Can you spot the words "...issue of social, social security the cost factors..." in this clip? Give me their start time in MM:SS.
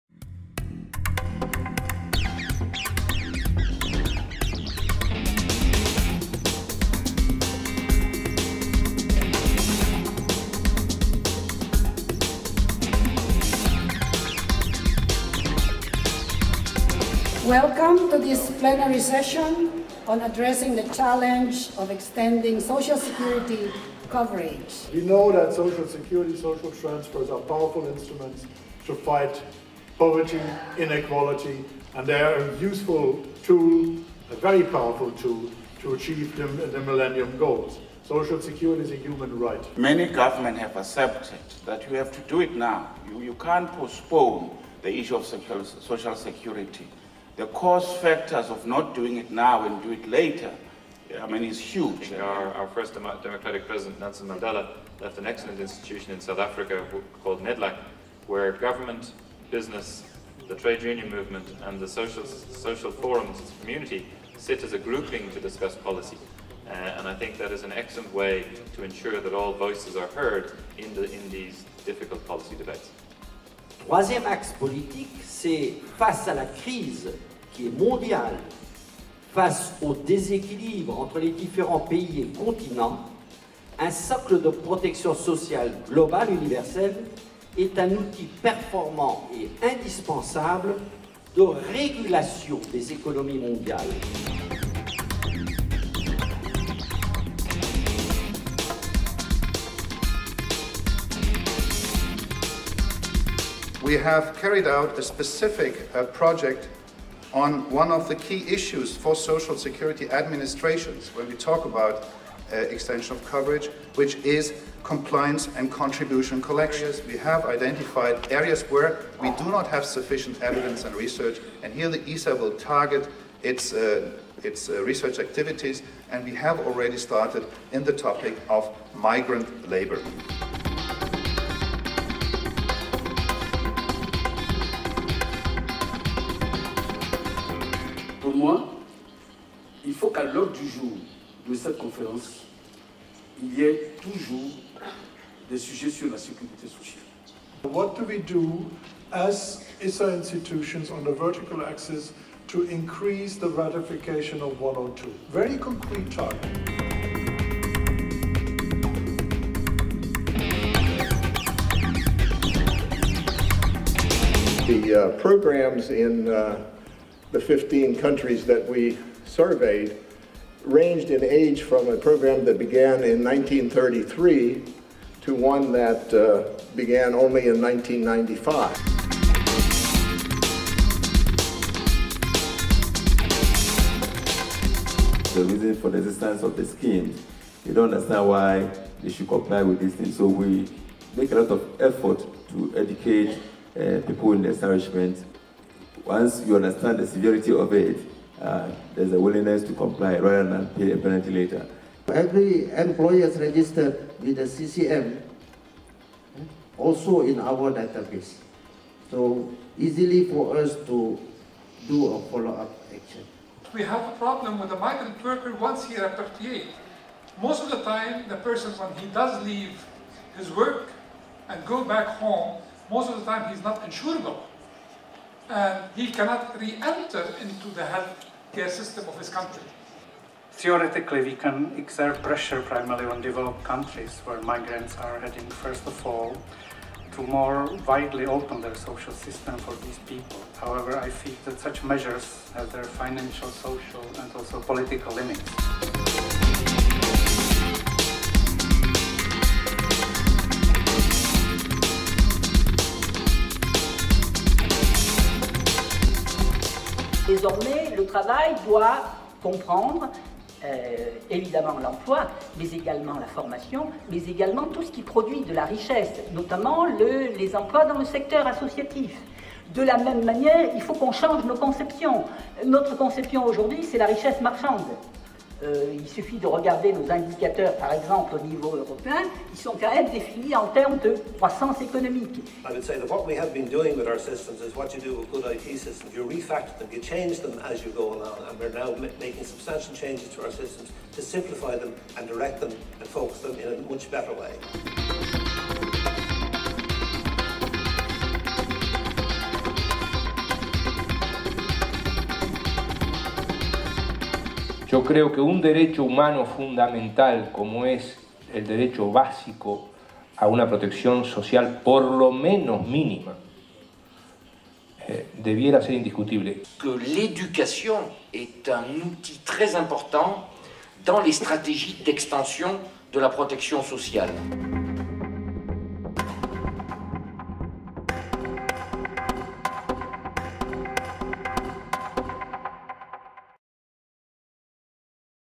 00:44.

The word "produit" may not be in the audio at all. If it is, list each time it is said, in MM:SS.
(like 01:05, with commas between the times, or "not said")
04:25.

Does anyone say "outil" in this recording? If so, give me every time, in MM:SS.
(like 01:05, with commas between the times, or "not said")
01:27, 05:19.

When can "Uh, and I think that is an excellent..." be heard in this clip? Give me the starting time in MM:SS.
01:06.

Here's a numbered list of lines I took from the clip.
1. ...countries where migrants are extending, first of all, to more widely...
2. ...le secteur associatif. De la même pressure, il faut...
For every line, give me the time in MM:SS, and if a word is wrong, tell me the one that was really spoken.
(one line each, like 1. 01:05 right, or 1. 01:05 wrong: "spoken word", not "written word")
1. 03:53 wrong: "heading", not "extending"
2. 04:27 wrong: "manière", not "pressure".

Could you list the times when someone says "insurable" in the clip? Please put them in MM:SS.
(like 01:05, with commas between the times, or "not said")
03:43.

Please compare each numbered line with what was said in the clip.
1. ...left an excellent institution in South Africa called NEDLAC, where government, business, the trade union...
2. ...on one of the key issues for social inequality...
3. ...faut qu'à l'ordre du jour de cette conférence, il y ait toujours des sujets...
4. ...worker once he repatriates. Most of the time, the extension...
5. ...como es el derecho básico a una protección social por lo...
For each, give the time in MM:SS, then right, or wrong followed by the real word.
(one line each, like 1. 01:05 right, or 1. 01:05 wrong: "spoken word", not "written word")
1. 00:54 right
2. 01:47 wrong: "security", not "inequality"
3. 02:19 right
4. 03:35 wrong: "person", not "extension"
5. 05:07 right.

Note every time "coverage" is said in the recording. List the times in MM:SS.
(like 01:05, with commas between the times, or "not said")
00:24, 01:53.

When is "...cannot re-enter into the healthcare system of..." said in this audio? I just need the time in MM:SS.
03:46.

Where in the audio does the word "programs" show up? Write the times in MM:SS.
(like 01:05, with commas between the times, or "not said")
02:45, 02:51.